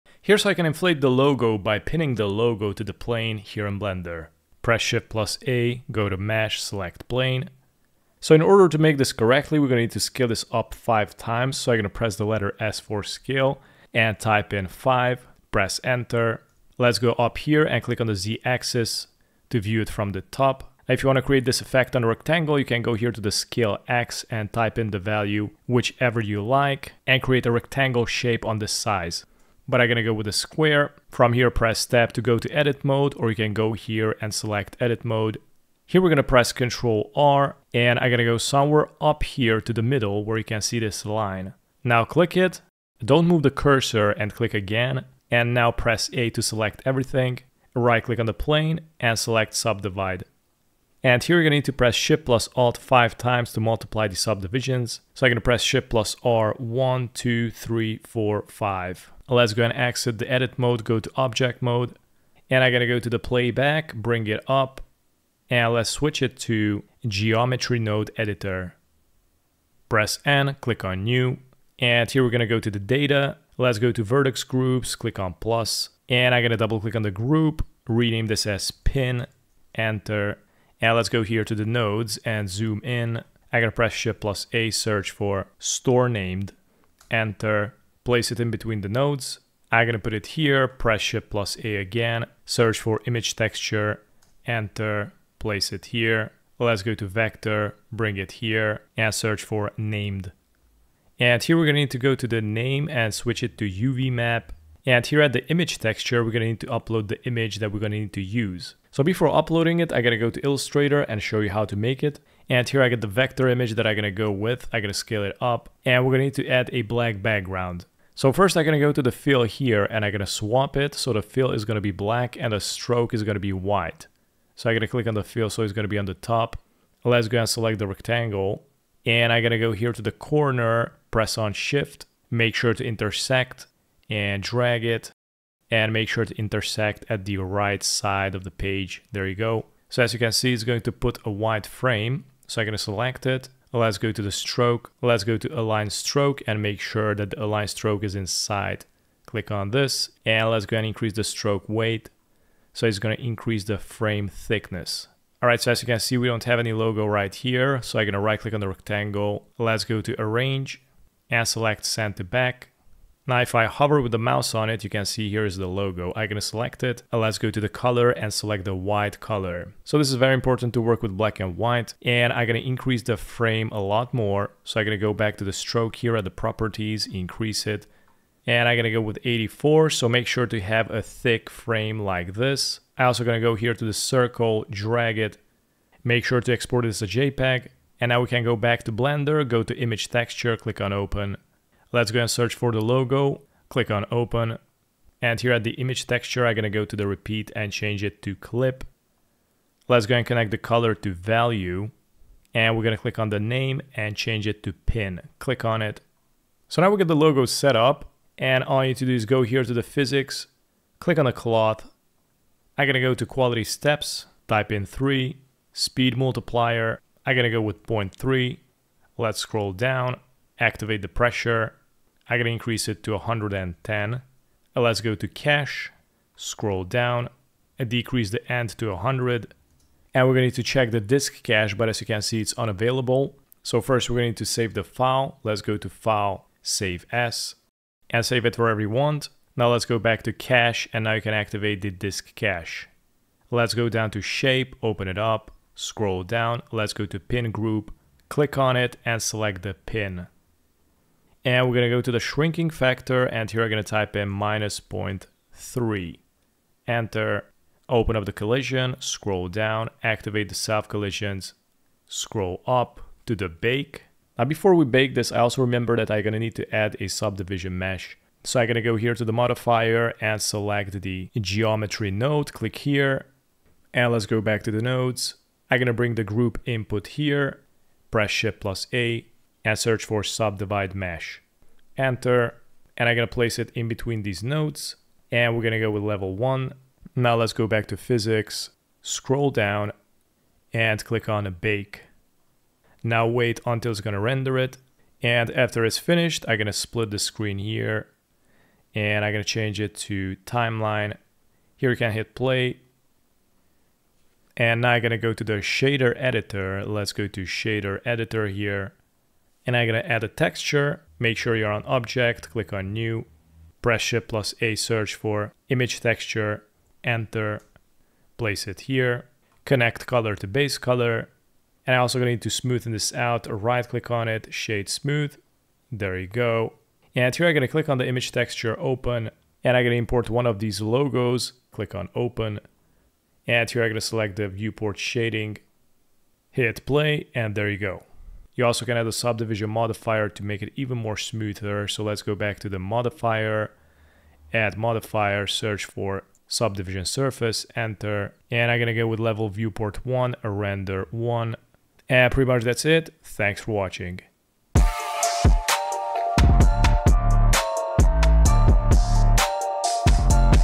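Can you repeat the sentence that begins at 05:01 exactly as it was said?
Here you can hit play, and now I'm gonna go to the shader editor.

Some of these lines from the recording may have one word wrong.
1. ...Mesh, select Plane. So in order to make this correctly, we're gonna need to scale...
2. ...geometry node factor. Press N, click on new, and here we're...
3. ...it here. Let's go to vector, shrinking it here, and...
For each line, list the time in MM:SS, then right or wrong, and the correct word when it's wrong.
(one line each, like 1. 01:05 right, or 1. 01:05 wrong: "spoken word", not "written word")
1. 00:06 right
2. 01:07 wrong: "editor", not "factor"
3. 01:35 wrong: "bring", not "shrinking".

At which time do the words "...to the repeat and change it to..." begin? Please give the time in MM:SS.
03:16.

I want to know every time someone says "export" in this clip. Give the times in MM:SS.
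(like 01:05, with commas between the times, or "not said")
03:06.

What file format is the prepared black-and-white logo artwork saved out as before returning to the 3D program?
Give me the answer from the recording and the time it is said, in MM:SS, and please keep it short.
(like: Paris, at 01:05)
JPEG, at 03:07.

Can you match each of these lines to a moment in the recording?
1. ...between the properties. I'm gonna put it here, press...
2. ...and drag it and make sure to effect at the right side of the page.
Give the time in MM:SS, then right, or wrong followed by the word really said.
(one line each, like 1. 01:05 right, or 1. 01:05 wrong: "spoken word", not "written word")
1. 01:28 wrong: "nodes", not "properties"
2. 02:14 wrong: "intersect", not "effect".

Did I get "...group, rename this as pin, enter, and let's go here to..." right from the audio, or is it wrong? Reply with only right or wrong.
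right.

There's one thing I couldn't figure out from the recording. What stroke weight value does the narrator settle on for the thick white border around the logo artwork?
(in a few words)
84.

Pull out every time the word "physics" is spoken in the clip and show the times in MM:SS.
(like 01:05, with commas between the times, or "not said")
03:29, 04:47.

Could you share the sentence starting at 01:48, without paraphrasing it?
So before uploading it, I gotta go to Illustrator and show you how to make it.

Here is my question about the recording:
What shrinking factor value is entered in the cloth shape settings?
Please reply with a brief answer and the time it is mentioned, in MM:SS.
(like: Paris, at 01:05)
-0.3, at 04:14.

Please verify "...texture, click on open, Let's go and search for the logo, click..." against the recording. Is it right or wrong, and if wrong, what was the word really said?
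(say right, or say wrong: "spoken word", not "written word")
right.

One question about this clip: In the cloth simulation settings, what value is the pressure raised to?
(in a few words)
110.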